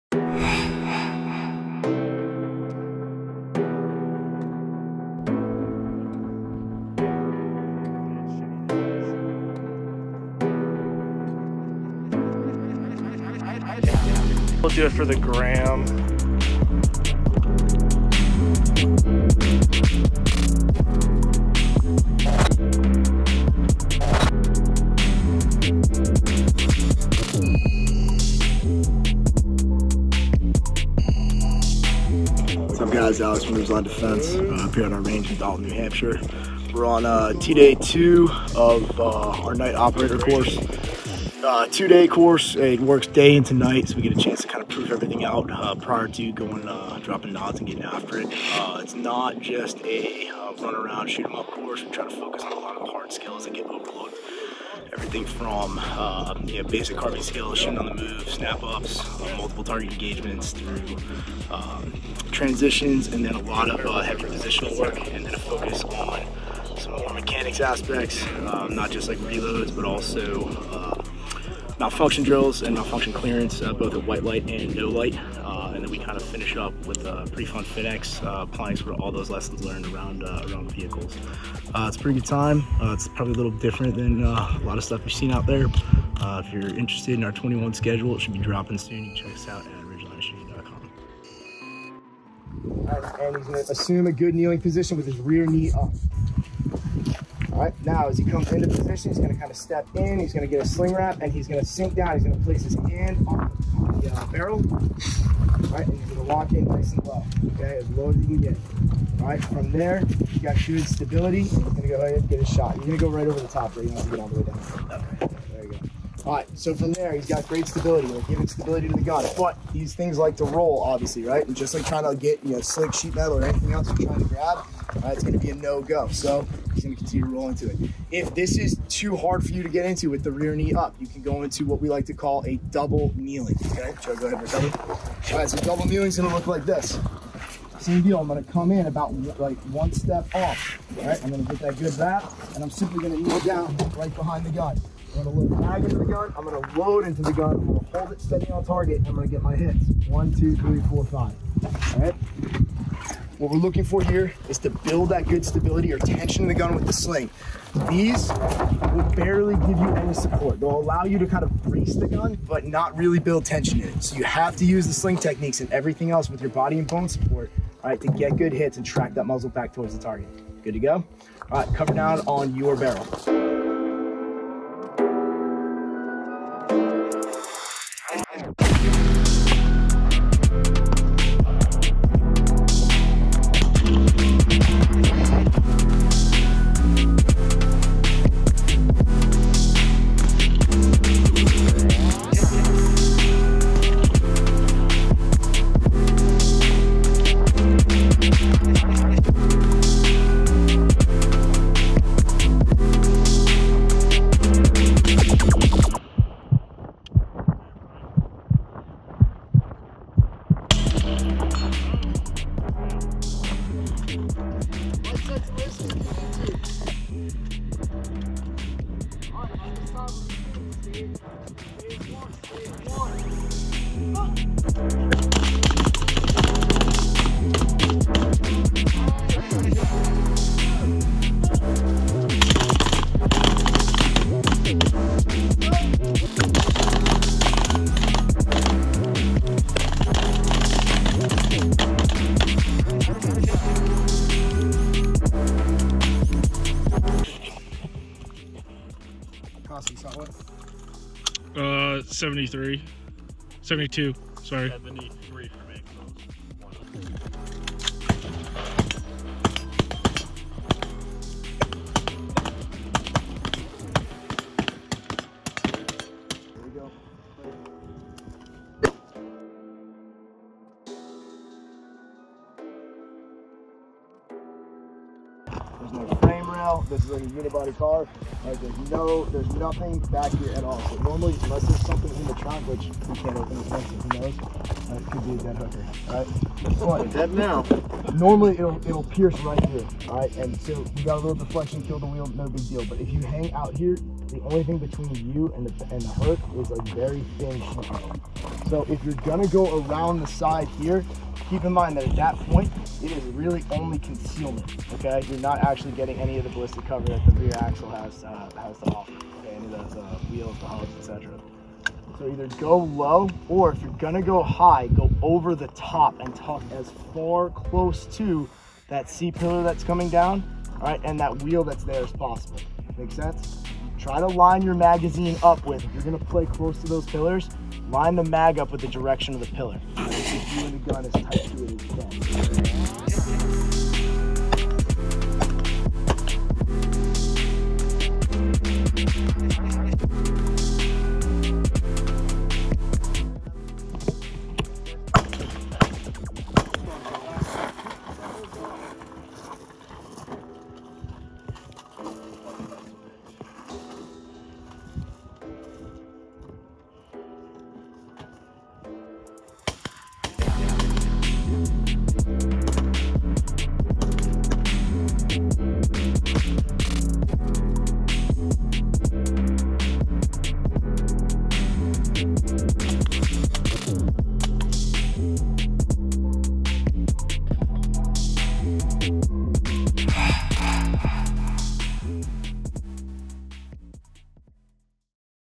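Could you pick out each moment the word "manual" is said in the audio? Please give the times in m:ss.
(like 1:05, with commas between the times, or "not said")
not said.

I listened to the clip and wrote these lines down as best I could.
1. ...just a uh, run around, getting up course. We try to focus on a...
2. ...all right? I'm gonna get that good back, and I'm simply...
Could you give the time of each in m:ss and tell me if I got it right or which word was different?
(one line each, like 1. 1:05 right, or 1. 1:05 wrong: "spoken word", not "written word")
1. 0:49 wrong: "shooting", not "getting"
2. 2:20 right.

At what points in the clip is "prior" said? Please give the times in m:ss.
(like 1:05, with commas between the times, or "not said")
0:45.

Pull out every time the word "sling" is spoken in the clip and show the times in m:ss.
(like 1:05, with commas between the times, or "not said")
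1:40, 2:36, 2:44.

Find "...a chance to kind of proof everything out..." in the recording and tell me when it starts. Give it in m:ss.
0:44.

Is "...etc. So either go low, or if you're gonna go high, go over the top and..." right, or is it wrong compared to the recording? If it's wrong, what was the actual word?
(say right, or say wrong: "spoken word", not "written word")
right.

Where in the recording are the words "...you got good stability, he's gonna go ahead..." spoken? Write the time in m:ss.
1:50.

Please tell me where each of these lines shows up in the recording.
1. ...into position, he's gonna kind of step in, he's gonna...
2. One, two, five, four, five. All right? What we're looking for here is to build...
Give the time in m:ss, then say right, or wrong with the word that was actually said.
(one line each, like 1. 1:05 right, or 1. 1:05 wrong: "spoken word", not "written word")
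1. 1:38 right
2. 2:30 wrong: "three", not "five".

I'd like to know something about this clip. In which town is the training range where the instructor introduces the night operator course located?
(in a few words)
Dalton, New Hampshire.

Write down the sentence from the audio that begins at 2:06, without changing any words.
So he's going to continue to roll into it.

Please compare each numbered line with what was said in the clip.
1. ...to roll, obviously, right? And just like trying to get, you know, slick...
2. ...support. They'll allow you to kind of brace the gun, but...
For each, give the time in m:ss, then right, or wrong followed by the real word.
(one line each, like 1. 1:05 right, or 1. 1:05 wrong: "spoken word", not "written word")
1. 2:00 right
2. 2:40 right.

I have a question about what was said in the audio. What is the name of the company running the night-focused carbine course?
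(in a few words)
Ridgeline Defense.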